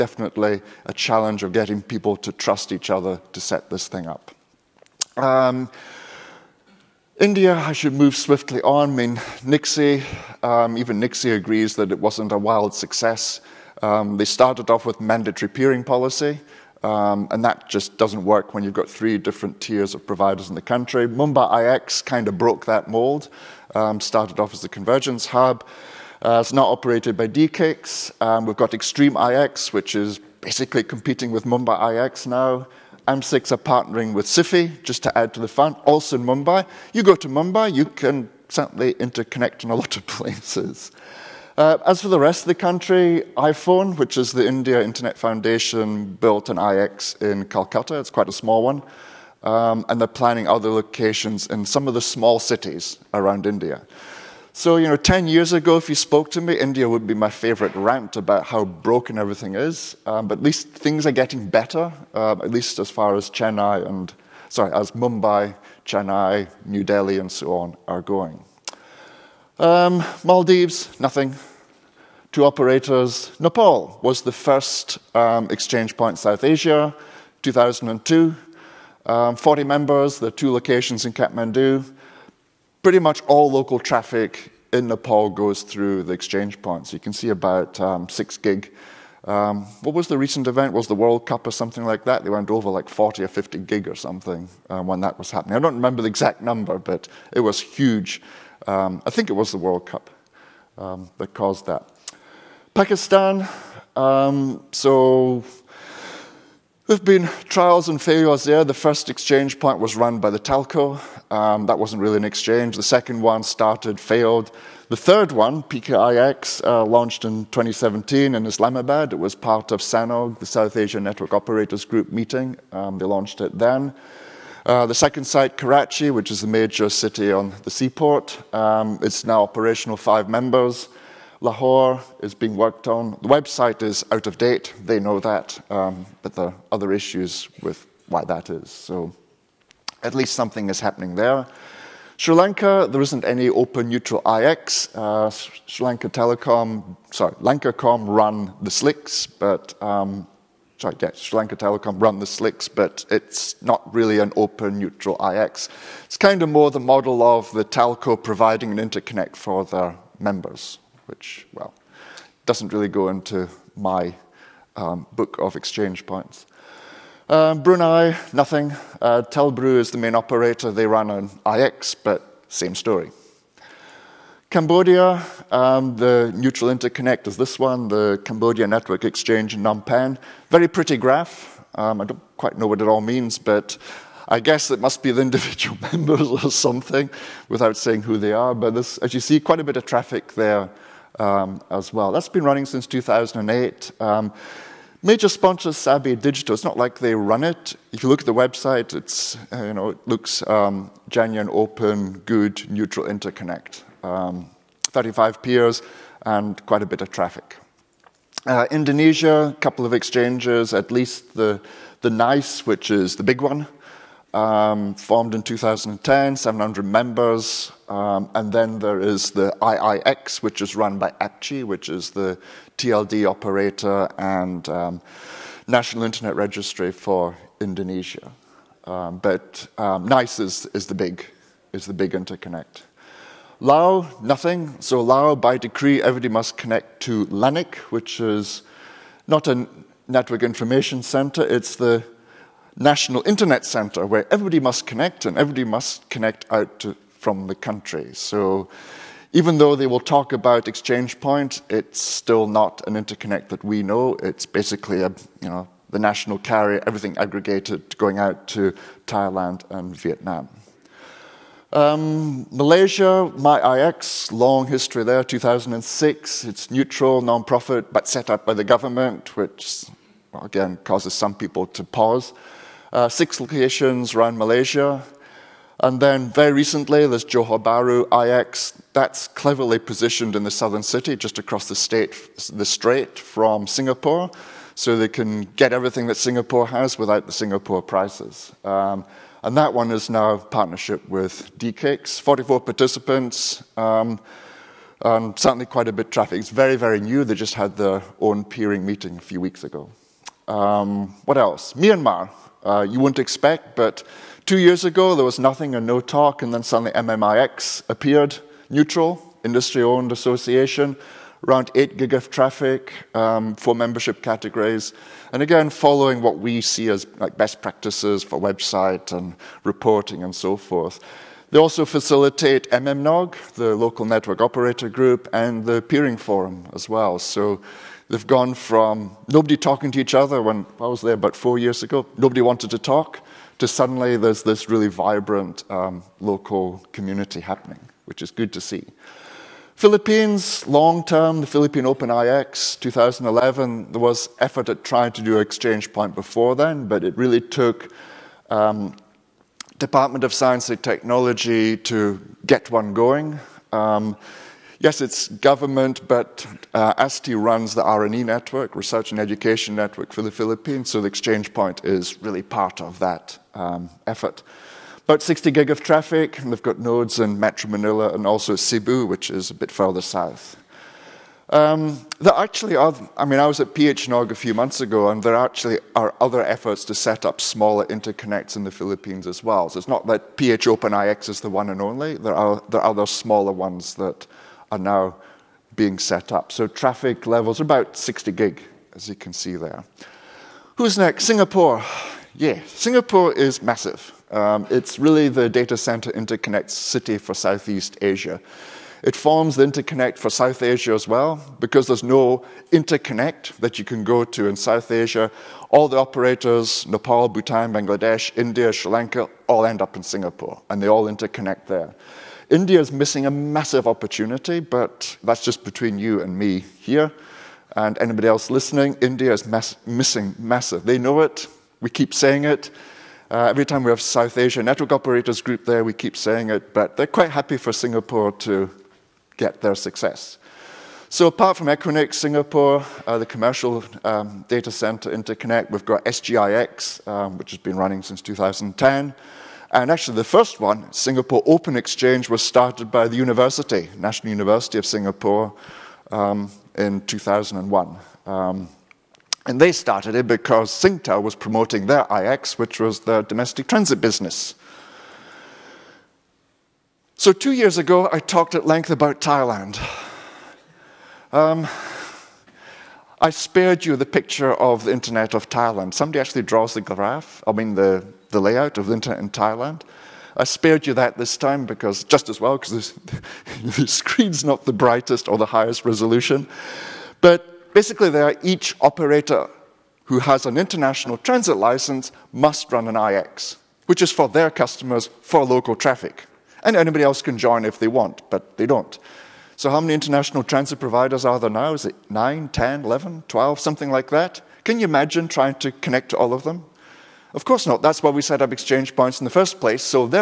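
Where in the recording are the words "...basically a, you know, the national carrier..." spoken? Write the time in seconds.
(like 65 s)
254 s.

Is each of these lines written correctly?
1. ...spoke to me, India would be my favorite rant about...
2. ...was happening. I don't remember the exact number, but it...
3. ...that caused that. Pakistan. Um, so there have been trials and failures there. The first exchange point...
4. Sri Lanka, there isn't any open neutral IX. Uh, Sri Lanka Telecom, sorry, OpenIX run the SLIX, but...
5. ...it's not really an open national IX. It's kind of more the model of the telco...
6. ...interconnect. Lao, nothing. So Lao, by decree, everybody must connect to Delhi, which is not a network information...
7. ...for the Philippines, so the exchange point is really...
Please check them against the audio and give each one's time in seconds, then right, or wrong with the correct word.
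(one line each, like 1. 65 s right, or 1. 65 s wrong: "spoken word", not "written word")
1. 55 s right
2. 95 s right
3. 101 s right
4. 142 s wrong: "Lankacom", not "OpenIX"
5. 153 s wrong: "neutral", not "national"
6. 232 s wrong: "LANIC", not "Delhi"
7. 360 s right.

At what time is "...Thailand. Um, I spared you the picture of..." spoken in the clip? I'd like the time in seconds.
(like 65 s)
459 s.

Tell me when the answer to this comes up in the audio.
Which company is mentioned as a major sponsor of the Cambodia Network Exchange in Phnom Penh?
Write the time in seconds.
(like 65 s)
195 s.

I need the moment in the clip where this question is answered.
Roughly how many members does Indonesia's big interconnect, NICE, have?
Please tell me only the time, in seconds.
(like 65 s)
216 s.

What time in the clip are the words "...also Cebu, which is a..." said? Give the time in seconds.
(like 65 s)
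368 s.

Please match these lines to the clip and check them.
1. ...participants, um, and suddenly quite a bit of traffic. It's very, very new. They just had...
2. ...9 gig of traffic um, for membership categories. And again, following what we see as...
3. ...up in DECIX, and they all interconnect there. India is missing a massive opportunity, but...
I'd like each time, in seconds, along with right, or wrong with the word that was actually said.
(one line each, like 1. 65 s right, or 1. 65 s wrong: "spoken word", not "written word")
1. 292 s wrong: "certainly", not "suddenly"
2. 311 s wrong: "8", not "9"
3. 409 s wrong: "Singapore", not "DECIX".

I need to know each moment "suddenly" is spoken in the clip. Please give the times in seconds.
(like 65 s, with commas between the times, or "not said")
306 s, 333 s.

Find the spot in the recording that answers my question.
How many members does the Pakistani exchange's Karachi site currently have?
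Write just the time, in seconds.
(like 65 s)
129 s.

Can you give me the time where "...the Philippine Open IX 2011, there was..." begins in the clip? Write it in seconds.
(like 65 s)
341 s.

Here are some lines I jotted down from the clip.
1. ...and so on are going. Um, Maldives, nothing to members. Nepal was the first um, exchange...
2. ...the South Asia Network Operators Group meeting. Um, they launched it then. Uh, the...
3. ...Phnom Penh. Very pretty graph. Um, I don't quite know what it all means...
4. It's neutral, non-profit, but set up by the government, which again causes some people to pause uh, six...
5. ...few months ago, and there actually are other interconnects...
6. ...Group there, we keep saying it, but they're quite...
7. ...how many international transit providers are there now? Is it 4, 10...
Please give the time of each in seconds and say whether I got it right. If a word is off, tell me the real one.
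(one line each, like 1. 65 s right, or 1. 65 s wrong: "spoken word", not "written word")
1. 67 s wrong: "operators", not "members"
2. 120 s right
3. 179 s right
4. 266 s right
5. 374 s wrong: "efforts", not "interconnects"
6. 425 s right
7. 489 s wrong: "9", not "4".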